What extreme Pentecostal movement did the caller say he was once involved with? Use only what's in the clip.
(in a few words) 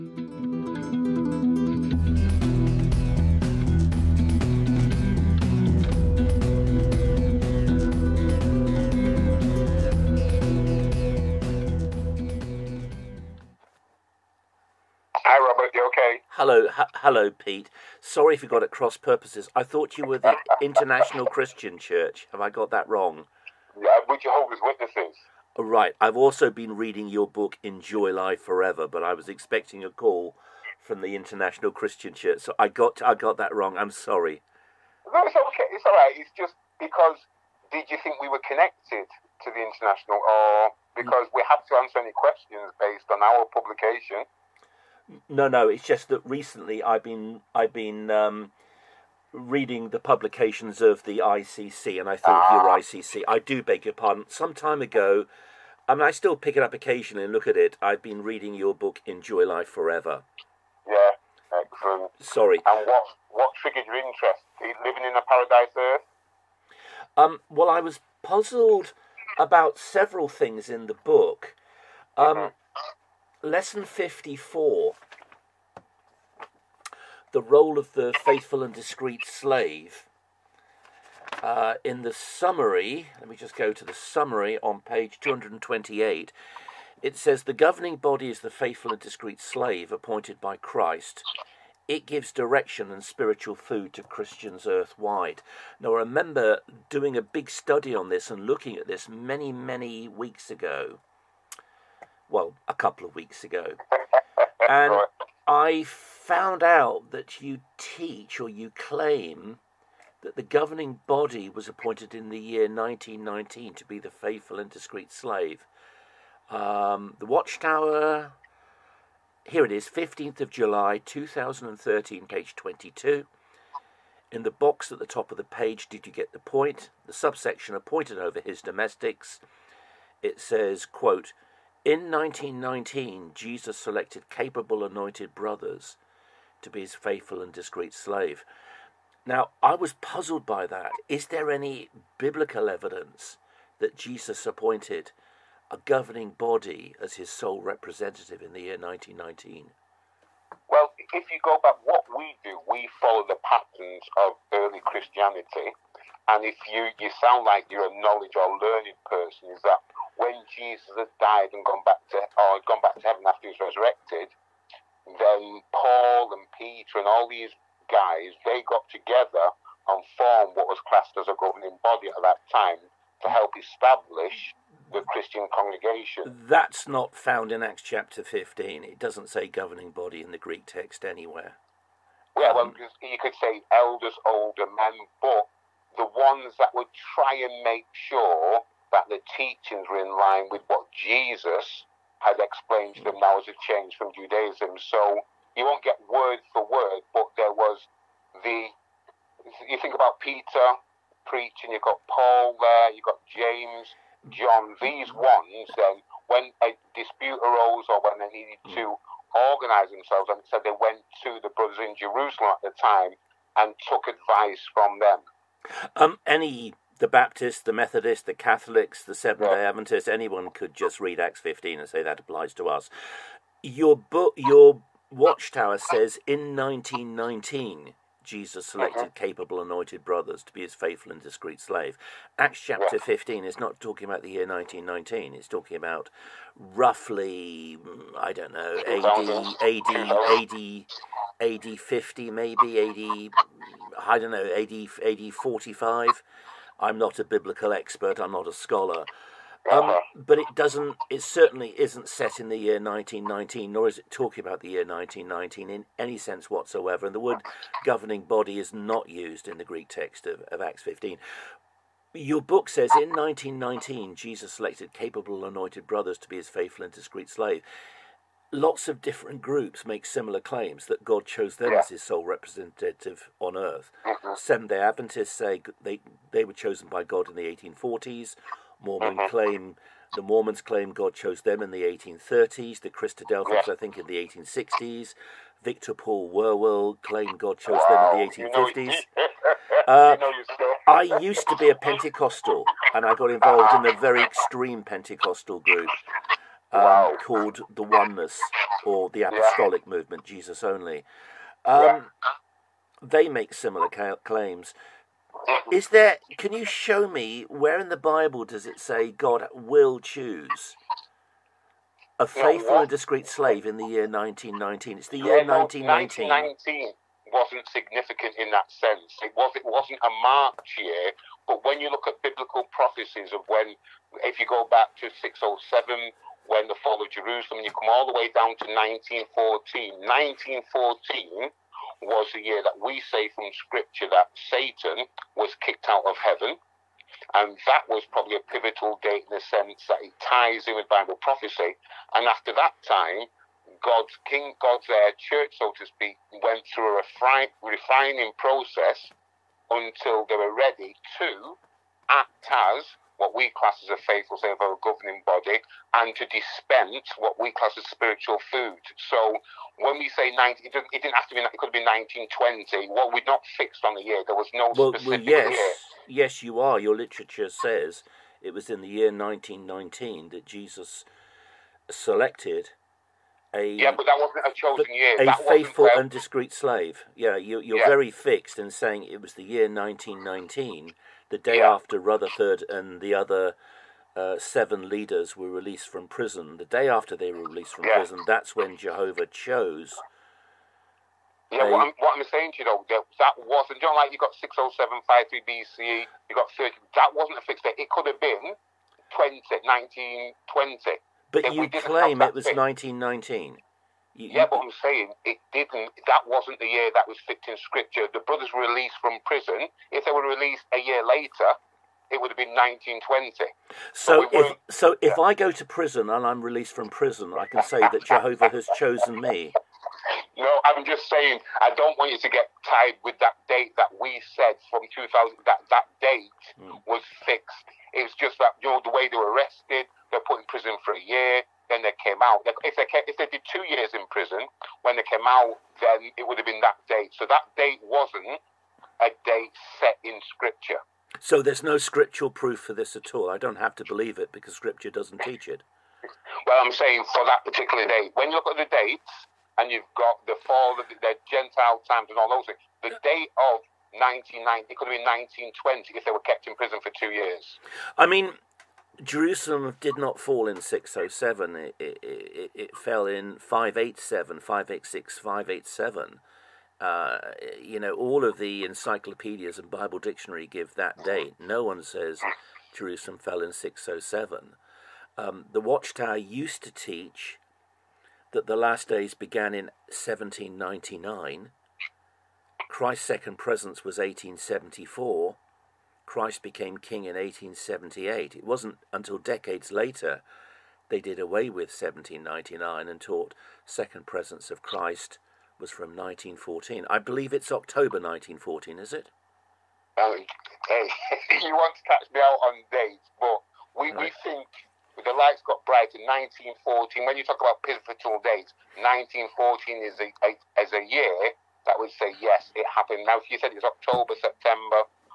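Oneness.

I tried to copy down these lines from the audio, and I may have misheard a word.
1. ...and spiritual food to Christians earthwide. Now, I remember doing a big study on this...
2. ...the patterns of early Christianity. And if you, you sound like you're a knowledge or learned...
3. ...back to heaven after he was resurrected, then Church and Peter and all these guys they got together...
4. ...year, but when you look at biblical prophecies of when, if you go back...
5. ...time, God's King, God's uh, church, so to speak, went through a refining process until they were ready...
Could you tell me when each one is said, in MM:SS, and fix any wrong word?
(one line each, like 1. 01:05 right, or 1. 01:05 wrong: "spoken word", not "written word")
1. 01:32 right
2. 02:33 right
3. 02:42 wrong: "Paul", not "Church"
4. 05:20 right
5. 05:42 right.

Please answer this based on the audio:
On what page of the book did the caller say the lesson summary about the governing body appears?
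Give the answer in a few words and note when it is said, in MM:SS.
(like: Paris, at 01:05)
228, at 01:24.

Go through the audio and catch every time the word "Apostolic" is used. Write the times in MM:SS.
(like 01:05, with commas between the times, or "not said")
04:59.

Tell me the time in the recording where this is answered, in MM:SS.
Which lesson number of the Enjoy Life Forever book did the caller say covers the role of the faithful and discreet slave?
01:13.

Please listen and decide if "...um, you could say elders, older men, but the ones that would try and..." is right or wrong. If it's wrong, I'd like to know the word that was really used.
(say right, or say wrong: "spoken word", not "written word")
right.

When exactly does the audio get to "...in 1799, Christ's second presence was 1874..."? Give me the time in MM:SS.
07:59.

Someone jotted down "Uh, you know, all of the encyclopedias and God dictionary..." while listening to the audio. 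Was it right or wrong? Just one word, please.
wrong.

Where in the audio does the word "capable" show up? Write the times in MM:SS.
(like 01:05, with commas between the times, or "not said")
02:14, 03:49, 04:24.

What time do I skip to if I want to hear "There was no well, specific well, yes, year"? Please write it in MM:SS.
06:04.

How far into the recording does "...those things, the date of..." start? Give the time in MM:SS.
07:32.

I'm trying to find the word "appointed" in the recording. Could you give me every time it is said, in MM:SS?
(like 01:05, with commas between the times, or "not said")
01:29, 01:51, 02:07, 02:24.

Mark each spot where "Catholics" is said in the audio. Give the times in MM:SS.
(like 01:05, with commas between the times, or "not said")
03:38.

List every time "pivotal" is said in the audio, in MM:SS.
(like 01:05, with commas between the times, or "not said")
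05:38, 08:27.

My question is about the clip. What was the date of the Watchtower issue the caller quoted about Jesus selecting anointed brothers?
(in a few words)
15 July 2013.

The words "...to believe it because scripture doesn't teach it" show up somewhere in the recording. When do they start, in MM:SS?
07:23.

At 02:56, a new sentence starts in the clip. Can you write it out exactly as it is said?
That's not found in Acts chapter 15.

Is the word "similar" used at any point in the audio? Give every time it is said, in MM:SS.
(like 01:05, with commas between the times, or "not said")
04:30, 05:03.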